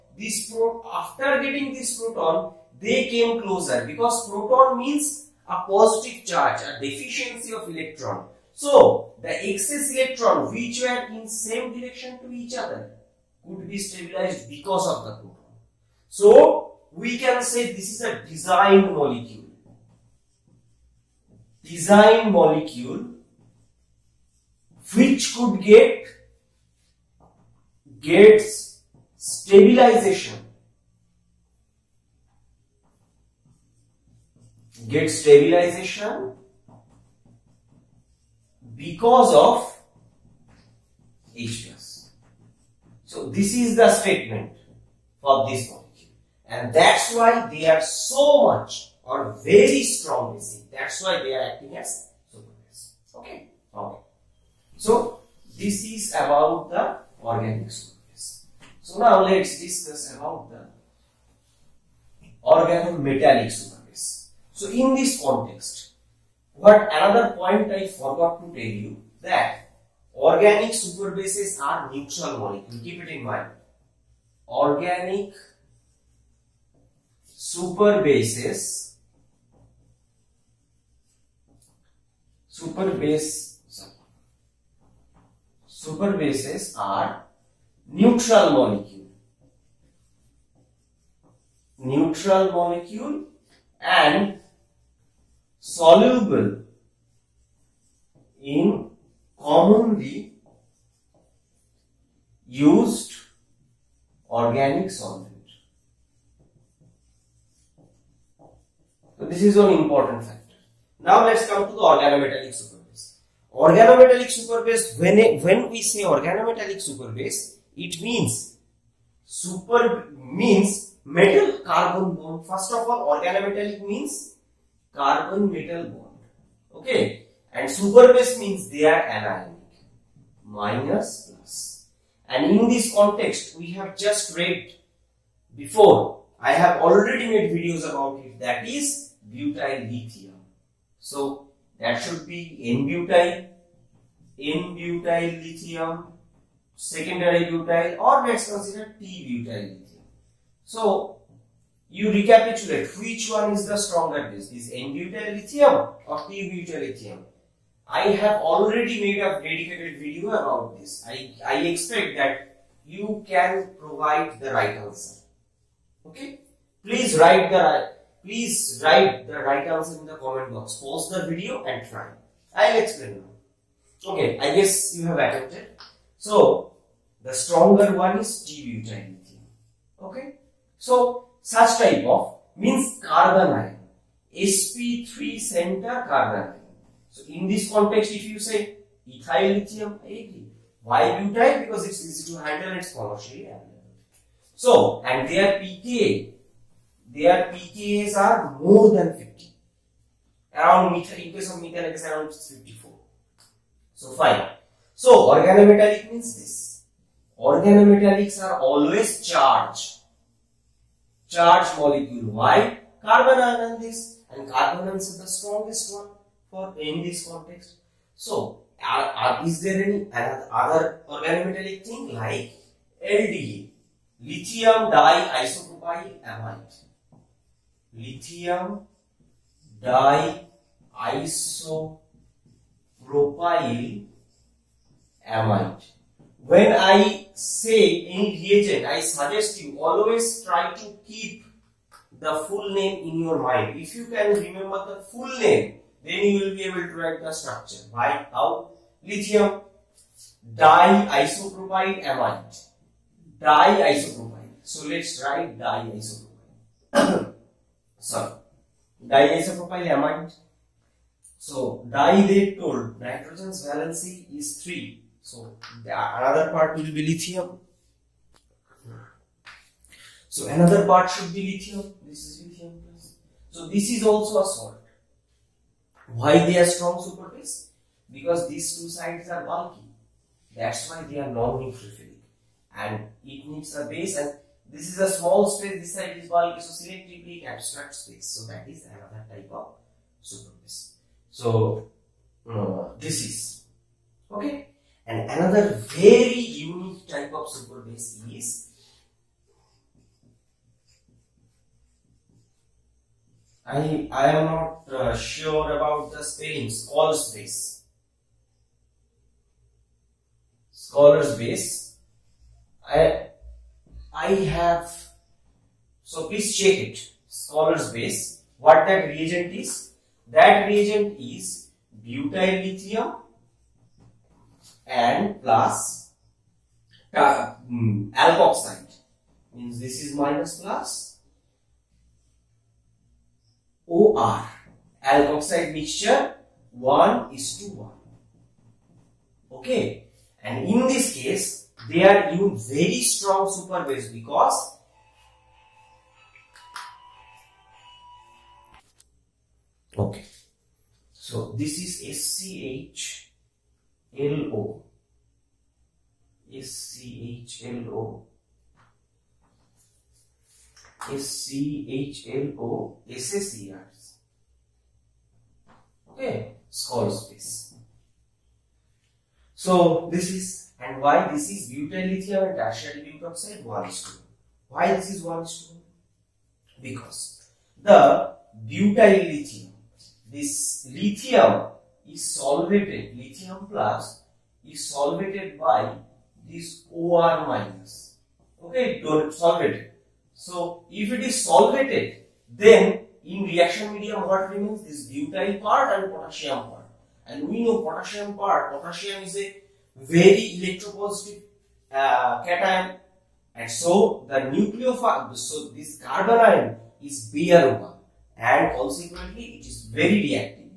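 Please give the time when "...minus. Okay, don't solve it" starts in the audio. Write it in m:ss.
6:27.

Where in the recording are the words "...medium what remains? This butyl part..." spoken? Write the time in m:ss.
6:33.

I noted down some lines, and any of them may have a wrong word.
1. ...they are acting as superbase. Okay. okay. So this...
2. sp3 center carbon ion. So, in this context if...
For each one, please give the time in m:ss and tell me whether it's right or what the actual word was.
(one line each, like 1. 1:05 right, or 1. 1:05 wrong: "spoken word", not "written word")
1. 0:51 right
2. 3:04 right.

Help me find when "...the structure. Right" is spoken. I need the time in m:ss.
4:07.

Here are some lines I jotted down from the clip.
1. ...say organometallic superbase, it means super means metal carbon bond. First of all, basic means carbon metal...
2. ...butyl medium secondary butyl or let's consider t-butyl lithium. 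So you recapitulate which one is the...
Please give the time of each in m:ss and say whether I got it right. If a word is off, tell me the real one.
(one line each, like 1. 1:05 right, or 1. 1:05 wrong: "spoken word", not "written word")
1. 1:55 wrong: "organometallic", not "basic"
2. 2:24 wrong: "lithium", not "medium".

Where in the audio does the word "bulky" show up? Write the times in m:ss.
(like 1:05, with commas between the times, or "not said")
4:39, 4:46.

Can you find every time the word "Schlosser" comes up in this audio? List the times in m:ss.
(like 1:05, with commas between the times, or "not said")
5:06, 5:10, 5:17.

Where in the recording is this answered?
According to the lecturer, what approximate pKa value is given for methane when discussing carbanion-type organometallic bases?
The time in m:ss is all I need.
3:22.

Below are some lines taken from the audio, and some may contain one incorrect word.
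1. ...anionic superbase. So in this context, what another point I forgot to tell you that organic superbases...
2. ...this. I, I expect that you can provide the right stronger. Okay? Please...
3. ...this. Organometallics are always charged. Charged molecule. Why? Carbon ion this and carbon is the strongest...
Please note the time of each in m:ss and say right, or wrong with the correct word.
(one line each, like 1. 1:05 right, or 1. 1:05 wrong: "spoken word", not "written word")
1. 1:02 wrong: "organometallic", not "anionic"
2. 2:40 wrong: "answer", not "stronger"
3. 3:26 right.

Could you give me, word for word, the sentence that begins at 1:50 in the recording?
Now let's come to the organometallic superbase.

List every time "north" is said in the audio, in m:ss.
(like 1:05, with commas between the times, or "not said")
not said.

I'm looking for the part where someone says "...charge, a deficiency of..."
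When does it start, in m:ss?
0:06.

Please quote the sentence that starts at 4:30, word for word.
So another part should be lithium.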